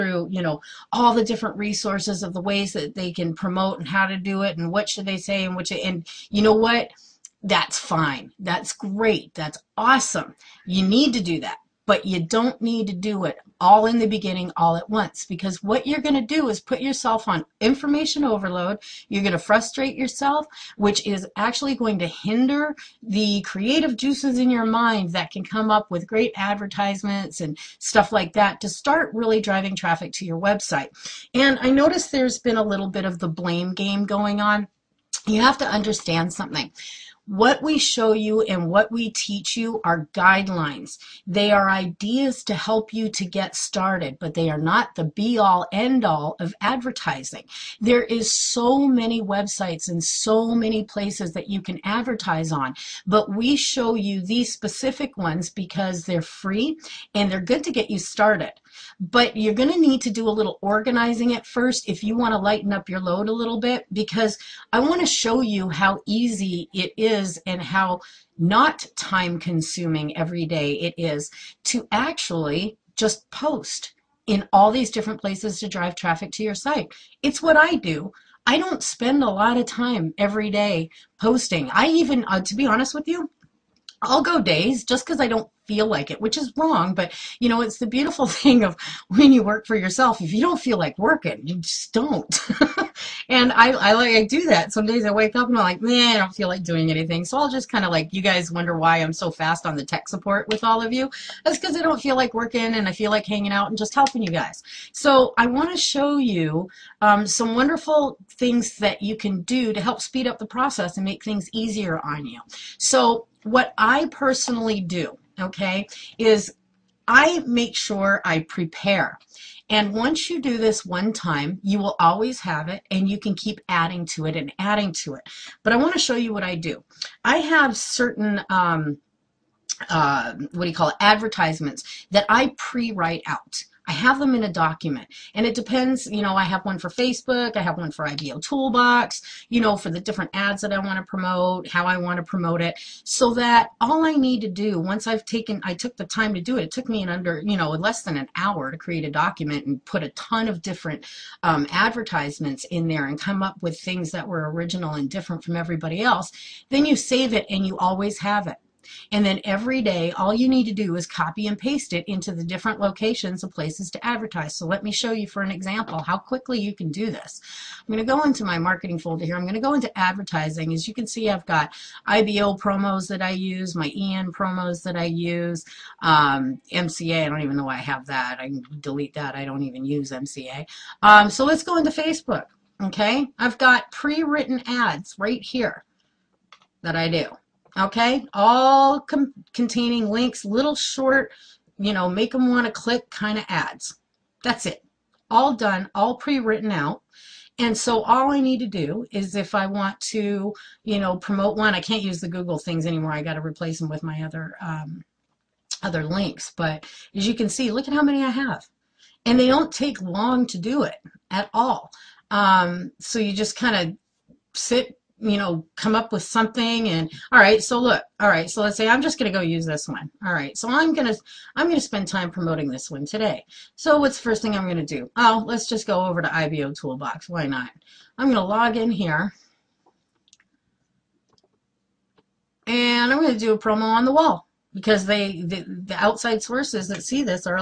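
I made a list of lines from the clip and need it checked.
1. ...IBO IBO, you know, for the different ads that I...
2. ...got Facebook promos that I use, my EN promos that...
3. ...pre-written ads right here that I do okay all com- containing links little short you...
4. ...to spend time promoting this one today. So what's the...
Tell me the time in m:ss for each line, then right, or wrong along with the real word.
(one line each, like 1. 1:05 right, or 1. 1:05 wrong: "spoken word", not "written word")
1. 2:18 wrong: "Toolbox", not "IBO"
2. 2:51 wrong: "IBO", not "Facebook"
3. 3:03 right
4. 3:41 right.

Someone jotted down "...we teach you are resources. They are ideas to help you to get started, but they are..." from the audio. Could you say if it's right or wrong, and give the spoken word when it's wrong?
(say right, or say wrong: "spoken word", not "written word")
wrong: "guidelines", not "resources".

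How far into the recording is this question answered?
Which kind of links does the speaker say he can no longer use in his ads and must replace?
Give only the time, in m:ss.
3:22.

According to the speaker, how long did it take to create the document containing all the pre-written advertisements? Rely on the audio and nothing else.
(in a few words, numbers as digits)
less than an hour.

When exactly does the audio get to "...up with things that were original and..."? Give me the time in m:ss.
2:33.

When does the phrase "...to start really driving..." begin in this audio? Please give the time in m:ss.
0:28.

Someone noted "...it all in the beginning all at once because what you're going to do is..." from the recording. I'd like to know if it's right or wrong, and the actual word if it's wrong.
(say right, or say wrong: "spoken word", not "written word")
right.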